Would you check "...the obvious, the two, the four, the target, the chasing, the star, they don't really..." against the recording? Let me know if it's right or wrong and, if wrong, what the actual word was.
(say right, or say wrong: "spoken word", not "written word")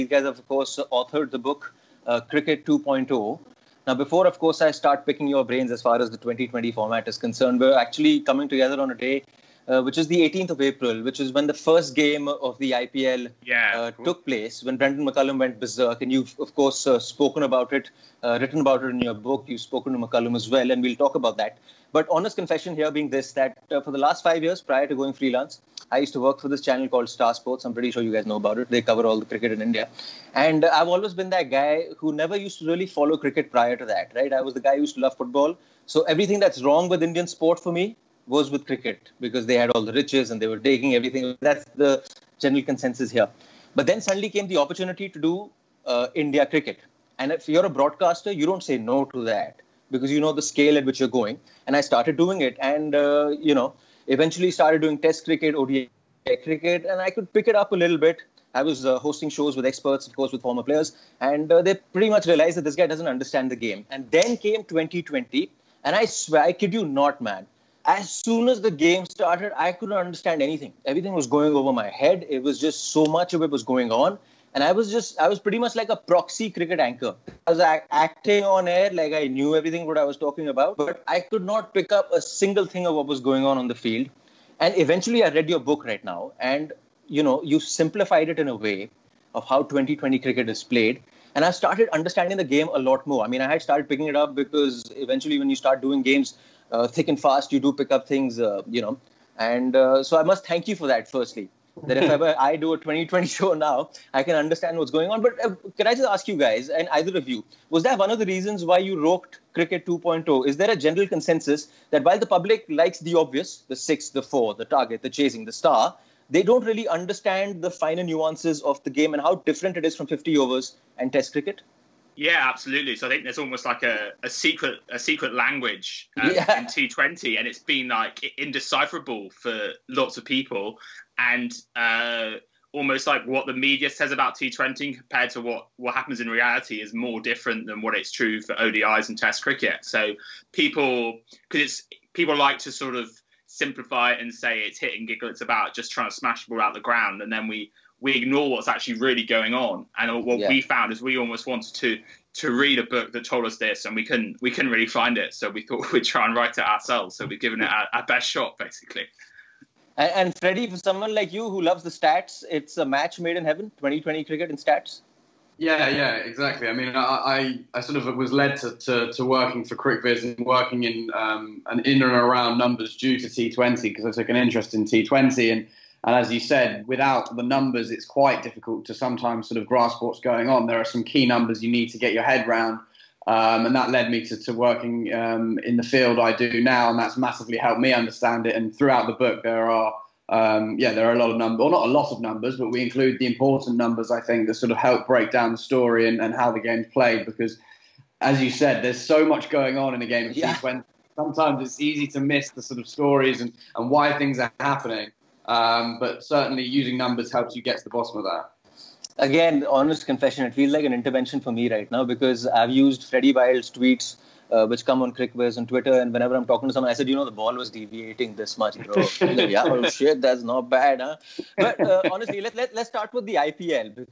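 wrong: "six", not "two".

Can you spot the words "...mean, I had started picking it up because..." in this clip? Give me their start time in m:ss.
1:33.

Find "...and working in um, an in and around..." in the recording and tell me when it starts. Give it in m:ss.
2:50.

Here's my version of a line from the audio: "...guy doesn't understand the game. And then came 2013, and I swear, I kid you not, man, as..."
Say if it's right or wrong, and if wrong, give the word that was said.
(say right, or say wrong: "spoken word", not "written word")
wrong: "2020", not "2013".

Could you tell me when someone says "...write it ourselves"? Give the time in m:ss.
2:36.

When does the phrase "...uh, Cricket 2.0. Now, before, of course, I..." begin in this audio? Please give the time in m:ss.
0:02.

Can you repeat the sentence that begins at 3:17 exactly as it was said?
Because, as you said, there's so much going on in a game of yeah.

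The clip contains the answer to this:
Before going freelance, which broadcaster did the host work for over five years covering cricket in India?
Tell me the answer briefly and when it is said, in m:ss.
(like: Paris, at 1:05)
Star Sports, at 0:27.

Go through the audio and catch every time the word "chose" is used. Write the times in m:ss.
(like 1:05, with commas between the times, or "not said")
not said.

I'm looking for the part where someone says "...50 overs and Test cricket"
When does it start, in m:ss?
2:00.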